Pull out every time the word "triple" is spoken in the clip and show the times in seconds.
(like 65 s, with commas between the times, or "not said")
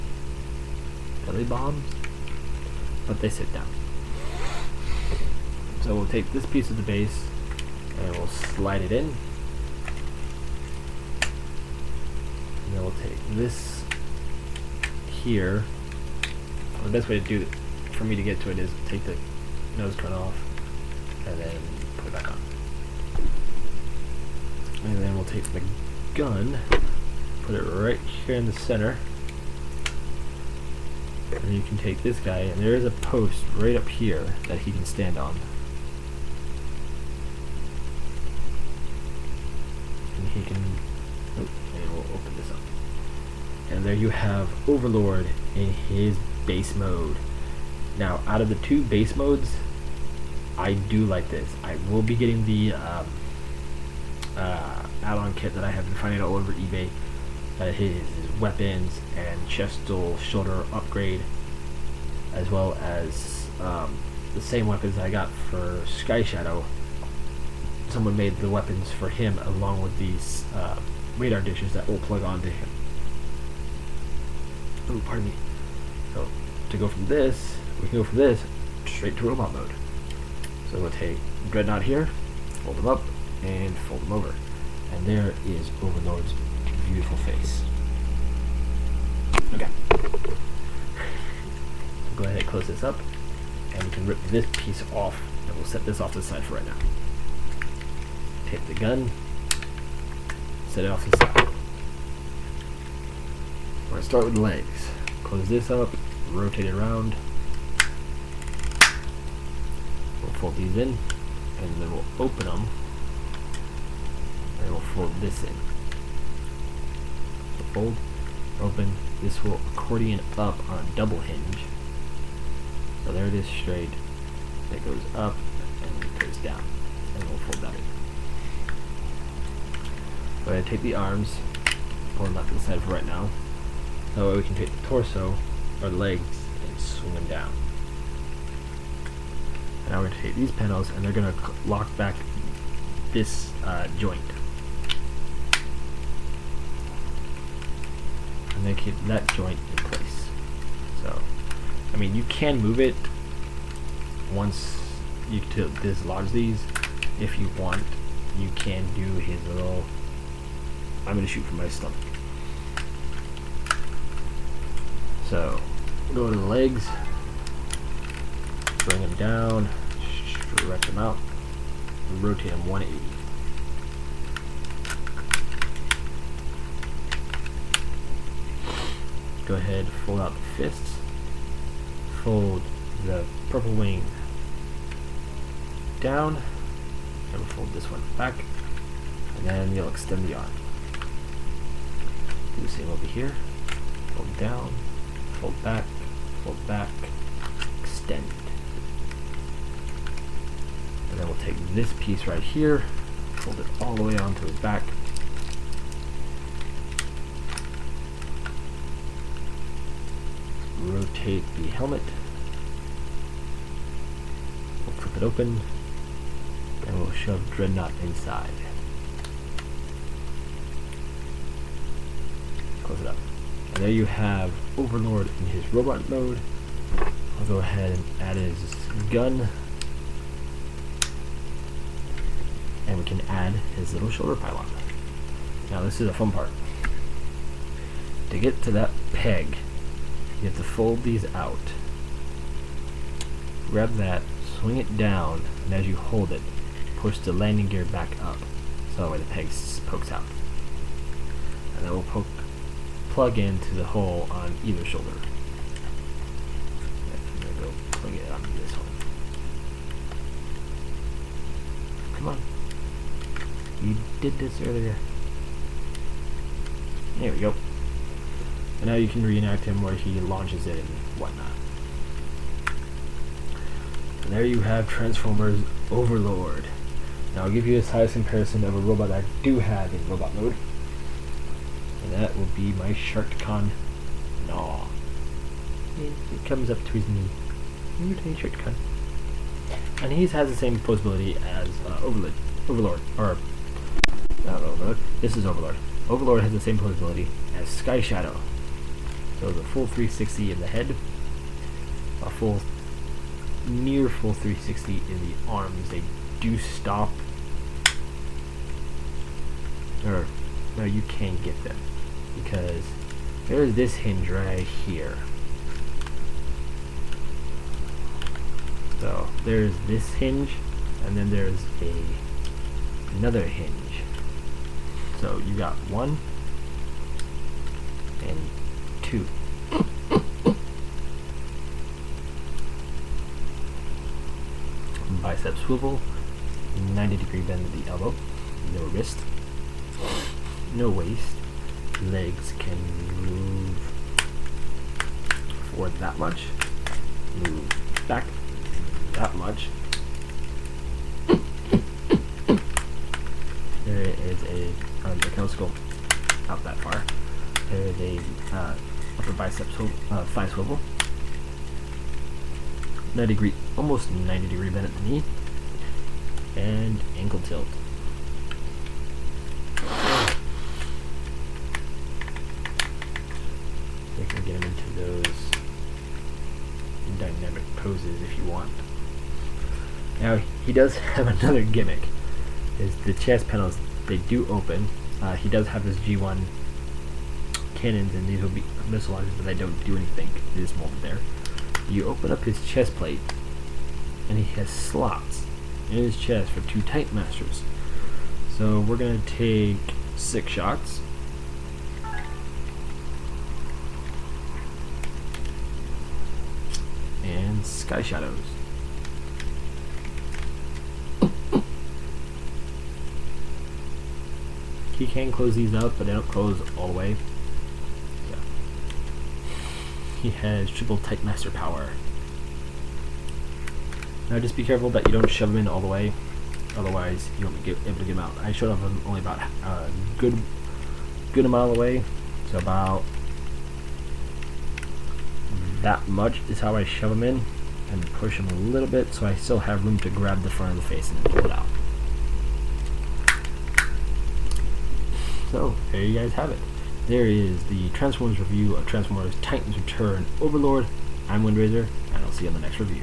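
420 s.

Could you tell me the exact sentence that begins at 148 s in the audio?
and then keep that joint in place.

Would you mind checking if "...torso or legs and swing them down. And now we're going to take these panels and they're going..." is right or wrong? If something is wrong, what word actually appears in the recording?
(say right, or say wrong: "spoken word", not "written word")
right.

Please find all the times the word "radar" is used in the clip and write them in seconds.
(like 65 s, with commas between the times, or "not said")
71 s.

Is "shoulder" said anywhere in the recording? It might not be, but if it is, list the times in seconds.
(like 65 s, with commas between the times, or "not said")
60 s, 234 s, 254 s.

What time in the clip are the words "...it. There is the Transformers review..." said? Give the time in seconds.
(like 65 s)
446 s.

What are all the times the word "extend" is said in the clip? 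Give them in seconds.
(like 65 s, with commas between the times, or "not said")
189 s, 197 s.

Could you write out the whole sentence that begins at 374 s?
We can get him into those dynamic poses if you want.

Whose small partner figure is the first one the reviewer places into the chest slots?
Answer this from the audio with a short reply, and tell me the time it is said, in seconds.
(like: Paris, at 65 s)
Sixshot, at 400 s.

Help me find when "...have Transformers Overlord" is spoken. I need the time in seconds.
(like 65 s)
274 s.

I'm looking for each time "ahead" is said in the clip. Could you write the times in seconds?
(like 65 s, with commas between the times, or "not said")
92 s, 179 s, 227 s.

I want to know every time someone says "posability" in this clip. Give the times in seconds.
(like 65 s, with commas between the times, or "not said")
290 s, 296 s.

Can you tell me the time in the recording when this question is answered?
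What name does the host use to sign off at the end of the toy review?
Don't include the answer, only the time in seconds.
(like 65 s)
451 s.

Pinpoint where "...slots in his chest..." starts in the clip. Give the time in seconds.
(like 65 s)
394 s.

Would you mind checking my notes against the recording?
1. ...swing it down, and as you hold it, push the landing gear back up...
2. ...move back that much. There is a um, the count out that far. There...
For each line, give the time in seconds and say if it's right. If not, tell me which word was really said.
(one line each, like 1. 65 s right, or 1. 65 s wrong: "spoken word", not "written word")
1. 244 s right
2. 347 s right.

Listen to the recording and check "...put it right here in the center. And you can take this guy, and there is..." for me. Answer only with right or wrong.
right.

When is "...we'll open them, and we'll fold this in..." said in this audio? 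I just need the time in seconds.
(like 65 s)
111 s.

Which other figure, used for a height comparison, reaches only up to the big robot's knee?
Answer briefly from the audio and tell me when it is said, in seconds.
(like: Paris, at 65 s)
Sharkticon Gnaw, at 282 s.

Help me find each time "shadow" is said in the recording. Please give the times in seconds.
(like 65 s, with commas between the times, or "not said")
66 s, 298 s, 408 s.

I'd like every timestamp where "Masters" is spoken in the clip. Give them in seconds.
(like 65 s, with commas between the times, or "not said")
397 s, 421 s.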